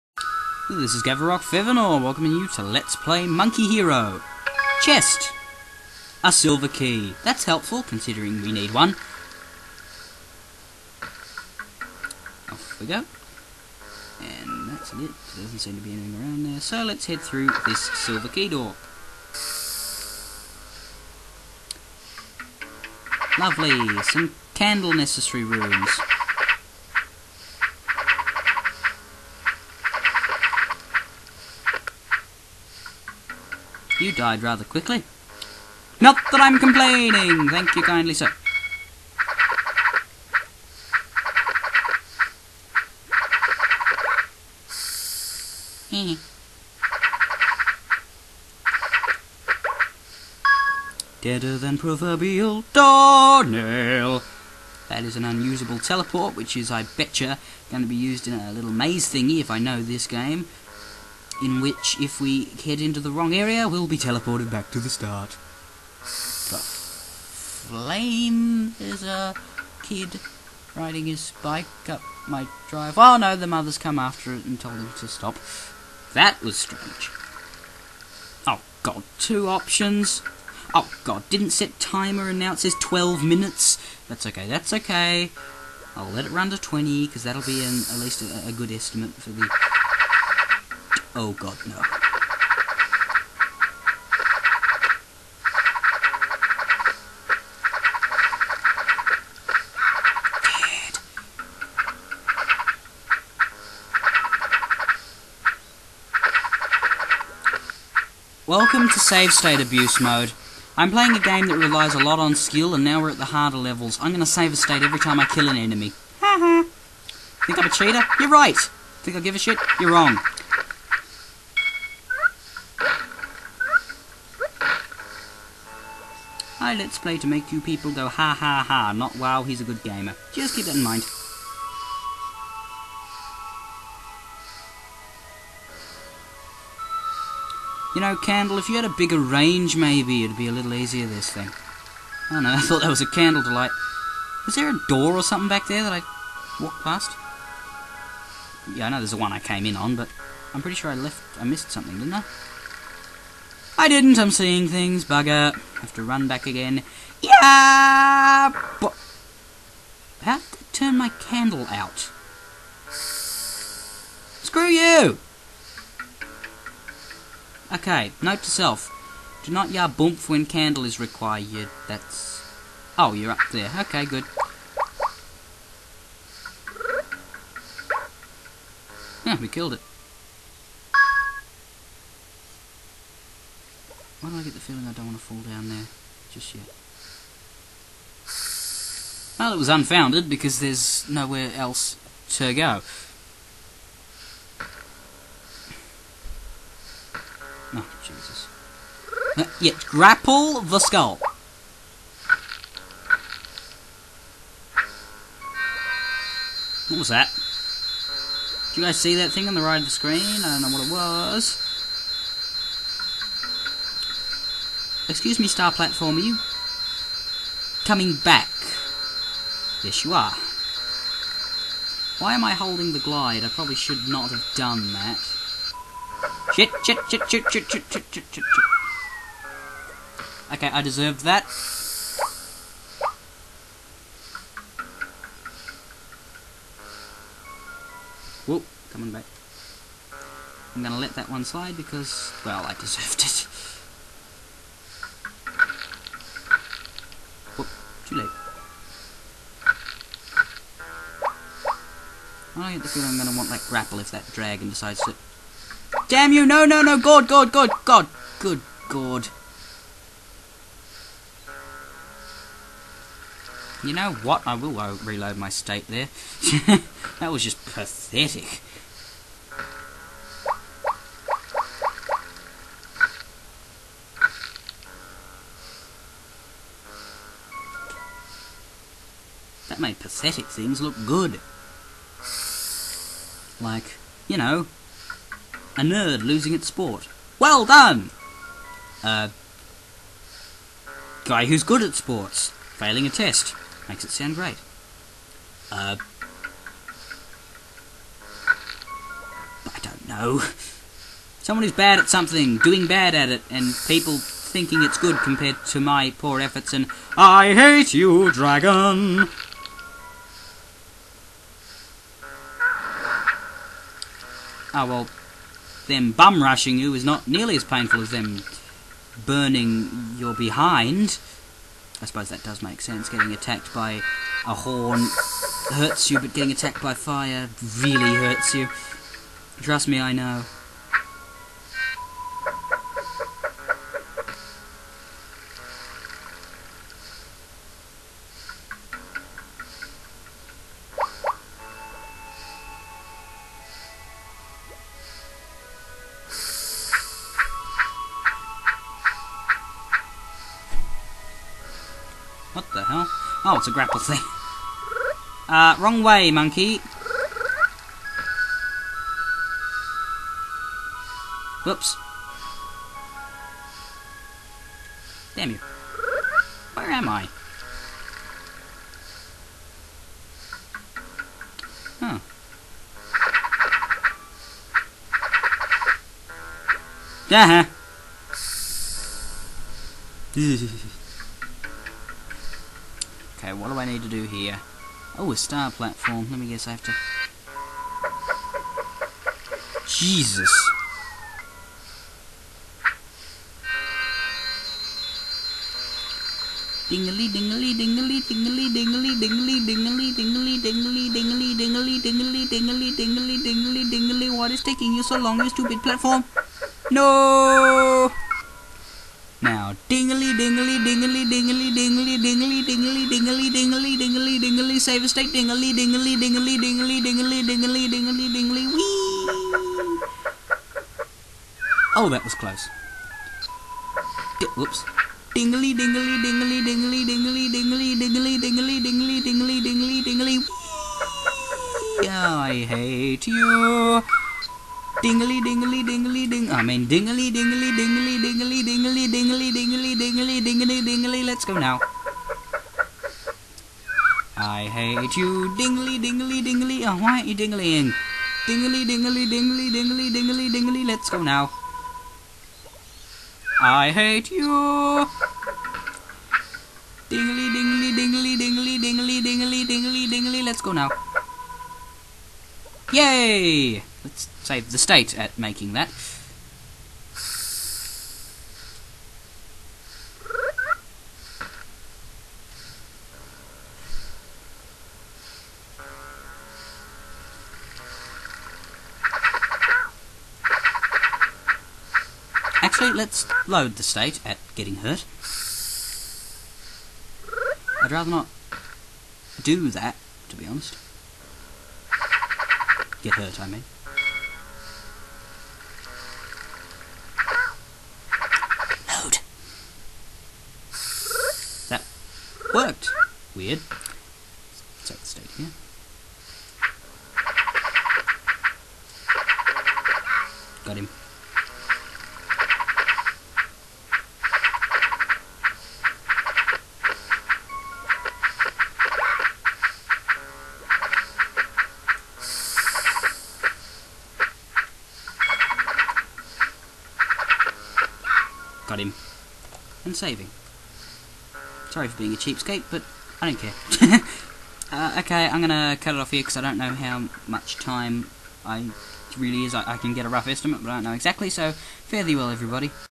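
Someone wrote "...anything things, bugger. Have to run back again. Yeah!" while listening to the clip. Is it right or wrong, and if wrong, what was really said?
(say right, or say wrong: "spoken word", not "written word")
wrong: "seeing", not "anything".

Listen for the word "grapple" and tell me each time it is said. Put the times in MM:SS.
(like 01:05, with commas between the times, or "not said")
03:19, 04:13, 05:53.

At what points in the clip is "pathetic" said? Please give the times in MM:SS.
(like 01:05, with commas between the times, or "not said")
04:27, 04:39.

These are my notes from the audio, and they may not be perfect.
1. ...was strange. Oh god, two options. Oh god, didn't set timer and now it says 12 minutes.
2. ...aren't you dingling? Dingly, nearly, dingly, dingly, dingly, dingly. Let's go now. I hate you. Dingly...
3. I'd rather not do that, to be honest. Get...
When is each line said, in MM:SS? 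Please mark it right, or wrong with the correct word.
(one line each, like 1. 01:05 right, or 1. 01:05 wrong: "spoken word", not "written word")
1. 01:16 right
2. 07:27 wrong: "dingly", not "nearly"
3. 08:07 right.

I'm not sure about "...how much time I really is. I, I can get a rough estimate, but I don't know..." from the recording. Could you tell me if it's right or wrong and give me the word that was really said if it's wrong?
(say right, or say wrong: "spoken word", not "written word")
right.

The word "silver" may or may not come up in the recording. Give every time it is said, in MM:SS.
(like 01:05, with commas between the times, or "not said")
00:06, 00:17.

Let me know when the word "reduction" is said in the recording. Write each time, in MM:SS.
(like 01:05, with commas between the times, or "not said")
not said.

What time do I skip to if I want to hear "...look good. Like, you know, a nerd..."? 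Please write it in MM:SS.
04:40.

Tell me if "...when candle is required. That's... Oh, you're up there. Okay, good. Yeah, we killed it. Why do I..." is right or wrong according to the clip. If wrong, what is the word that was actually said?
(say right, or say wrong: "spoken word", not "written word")
right.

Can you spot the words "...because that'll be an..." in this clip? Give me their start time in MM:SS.
01:27.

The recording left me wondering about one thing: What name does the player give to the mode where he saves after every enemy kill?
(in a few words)
Save state abuse mode.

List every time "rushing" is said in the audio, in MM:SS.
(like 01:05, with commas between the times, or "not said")
05:16.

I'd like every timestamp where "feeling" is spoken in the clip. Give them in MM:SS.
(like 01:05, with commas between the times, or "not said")
03:04, 04:12.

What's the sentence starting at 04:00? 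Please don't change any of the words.
I'm gonna let that one slide because, well, I deserved it.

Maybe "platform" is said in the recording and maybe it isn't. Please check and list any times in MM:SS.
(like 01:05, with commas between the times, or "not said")
03:35, 06:25, 06:45.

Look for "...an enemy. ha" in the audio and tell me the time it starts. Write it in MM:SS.
01:55.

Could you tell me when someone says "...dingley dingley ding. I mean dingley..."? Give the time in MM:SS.
07:15.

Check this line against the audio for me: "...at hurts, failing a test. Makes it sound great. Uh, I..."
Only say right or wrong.
wrong.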